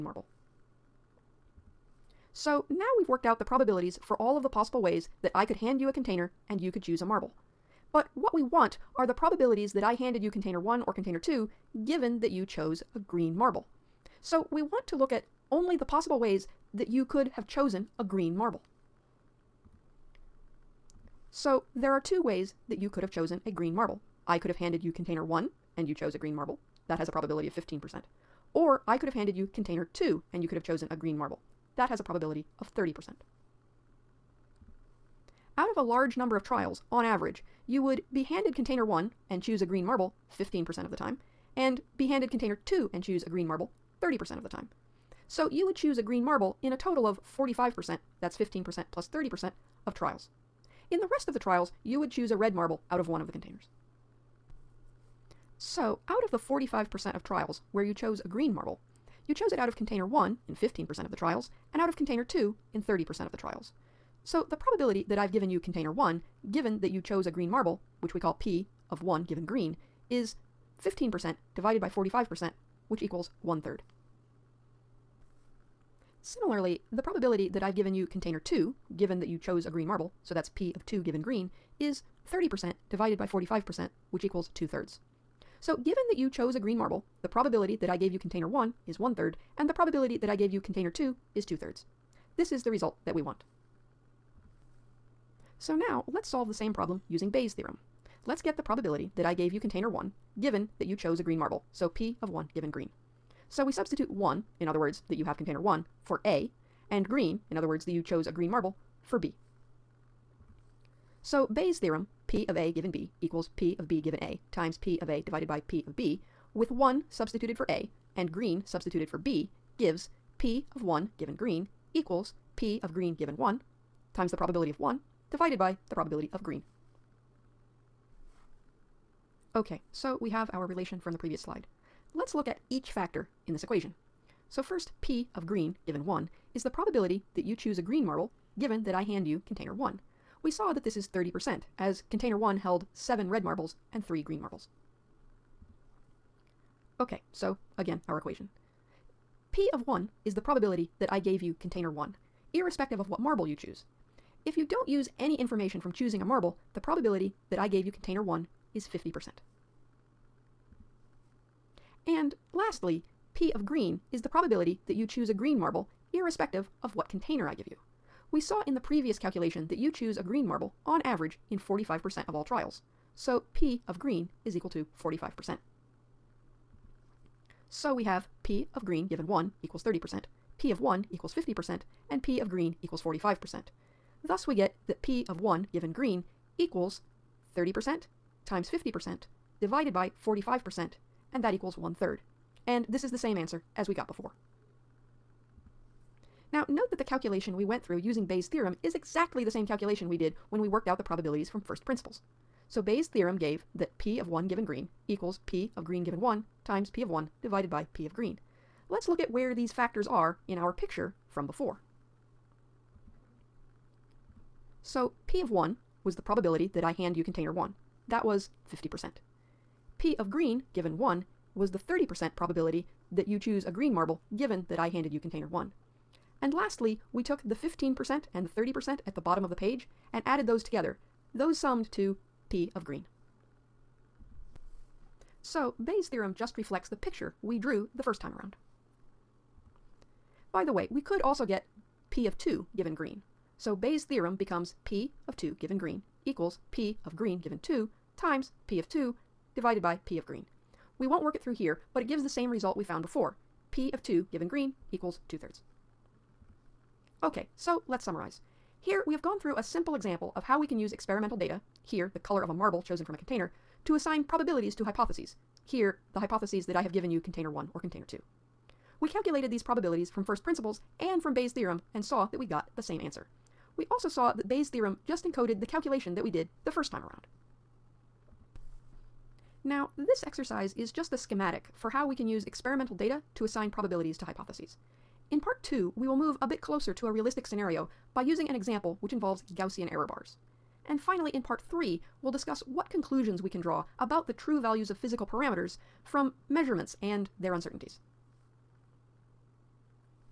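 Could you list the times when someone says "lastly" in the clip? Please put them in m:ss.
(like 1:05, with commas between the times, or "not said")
2:42, 3:46.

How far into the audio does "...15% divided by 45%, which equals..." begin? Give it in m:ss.
1:10.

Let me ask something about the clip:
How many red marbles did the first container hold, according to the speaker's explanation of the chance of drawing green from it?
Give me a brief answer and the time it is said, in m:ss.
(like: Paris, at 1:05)
7, at 2:22.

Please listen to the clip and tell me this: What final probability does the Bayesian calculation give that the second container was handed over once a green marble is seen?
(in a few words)
2/3.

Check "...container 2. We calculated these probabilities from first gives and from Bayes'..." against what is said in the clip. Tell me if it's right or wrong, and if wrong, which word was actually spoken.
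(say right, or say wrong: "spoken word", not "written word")
wrong: "principles", not "gives".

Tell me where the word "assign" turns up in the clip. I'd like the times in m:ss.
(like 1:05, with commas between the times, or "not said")
4:23, 4:43.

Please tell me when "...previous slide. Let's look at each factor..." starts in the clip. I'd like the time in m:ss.
2:11.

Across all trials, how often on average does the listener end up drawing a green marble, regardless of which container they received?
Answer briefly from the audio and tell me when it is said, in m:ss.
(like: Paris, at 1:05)
45%, at 0:45.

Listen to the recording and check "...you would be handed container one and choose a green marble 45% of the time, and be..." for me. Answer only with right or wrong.
wrong.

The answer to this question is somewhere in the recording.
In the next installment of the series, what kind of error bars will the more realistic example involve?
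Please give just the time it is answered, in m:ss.
4:49.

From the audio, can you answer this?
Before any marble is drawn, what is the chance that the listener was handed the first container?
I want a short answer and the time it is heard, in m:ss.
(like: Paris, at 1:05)
50%, at 2:36.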